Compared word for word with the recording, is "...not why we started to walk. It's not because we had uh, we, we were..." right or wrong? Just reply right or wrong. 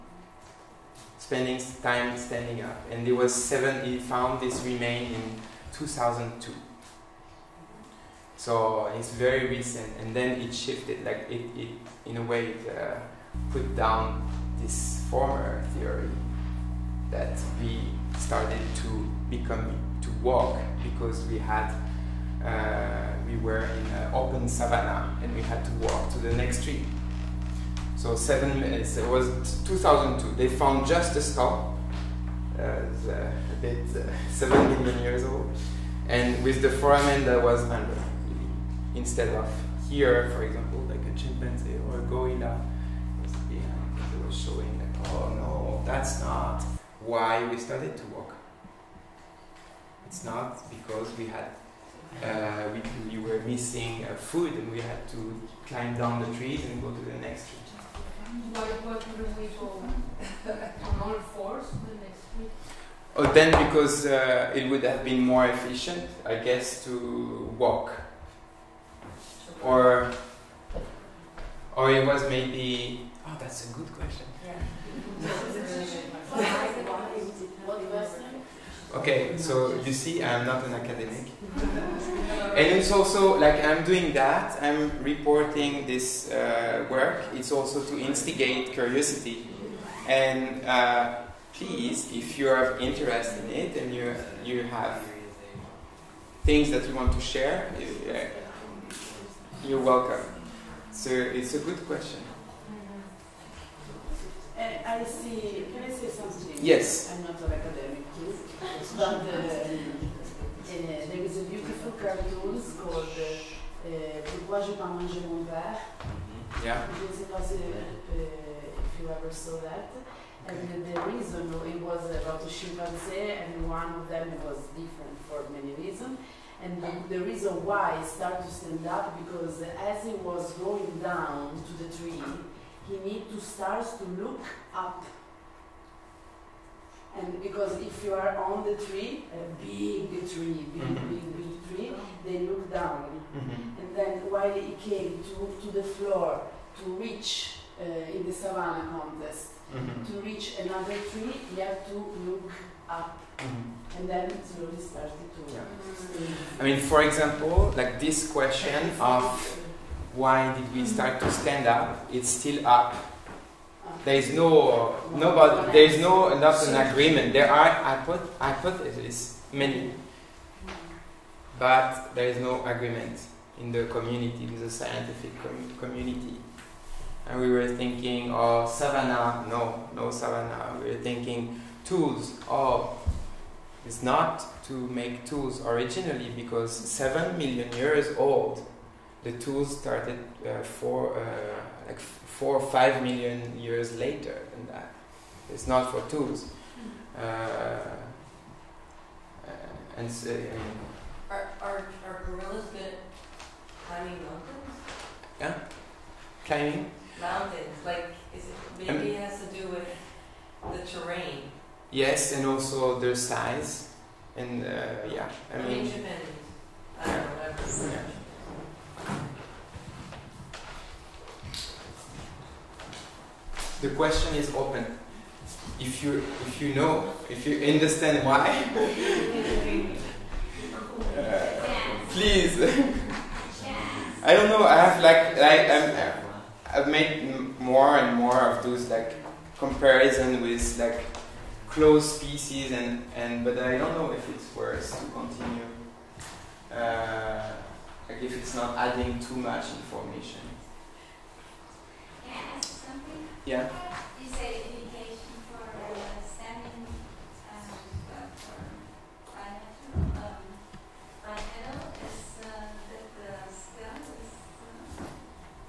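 right.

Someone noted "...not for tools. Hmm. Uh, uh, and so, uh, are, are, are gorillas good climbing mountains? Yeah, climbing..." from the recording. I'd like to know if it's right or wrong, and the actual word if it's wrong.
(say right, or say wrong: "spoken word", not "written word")
right.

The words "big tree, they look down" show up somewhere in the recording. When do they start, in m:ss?
2:21.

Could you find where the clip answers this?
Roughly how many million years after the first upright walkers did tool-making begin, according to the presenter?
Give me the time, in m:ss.
3:11.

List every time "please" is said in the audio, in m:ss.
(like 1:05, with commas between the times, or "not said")
1:31, 3:52.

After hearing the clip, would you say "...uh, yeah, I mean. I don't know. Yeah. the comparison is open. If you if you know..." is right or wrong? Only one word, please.
wrong.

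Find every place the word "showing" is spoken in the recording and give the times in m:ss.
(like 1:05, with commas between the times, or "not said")
0:44.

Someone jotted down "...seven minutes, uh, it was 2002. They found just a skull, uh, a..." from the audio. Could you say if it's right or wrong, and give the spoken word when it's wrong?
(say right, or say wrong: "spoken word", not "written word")
right.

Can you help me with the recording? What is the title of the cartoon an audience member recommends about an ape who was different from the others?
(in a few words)
Pourquoi je pas manger mon verre?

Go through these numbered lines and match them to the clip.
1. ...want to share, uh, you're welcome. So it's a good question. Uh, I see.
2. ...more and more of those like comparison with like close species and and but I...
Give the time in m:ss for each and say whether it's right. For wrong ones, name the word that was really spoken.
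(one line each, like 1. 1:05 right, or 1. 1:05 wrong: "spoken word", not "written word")
1. 1:36 right
2. 3:57 right.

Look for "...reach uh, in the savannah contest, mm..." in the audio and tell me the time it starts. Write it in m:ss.
2:27.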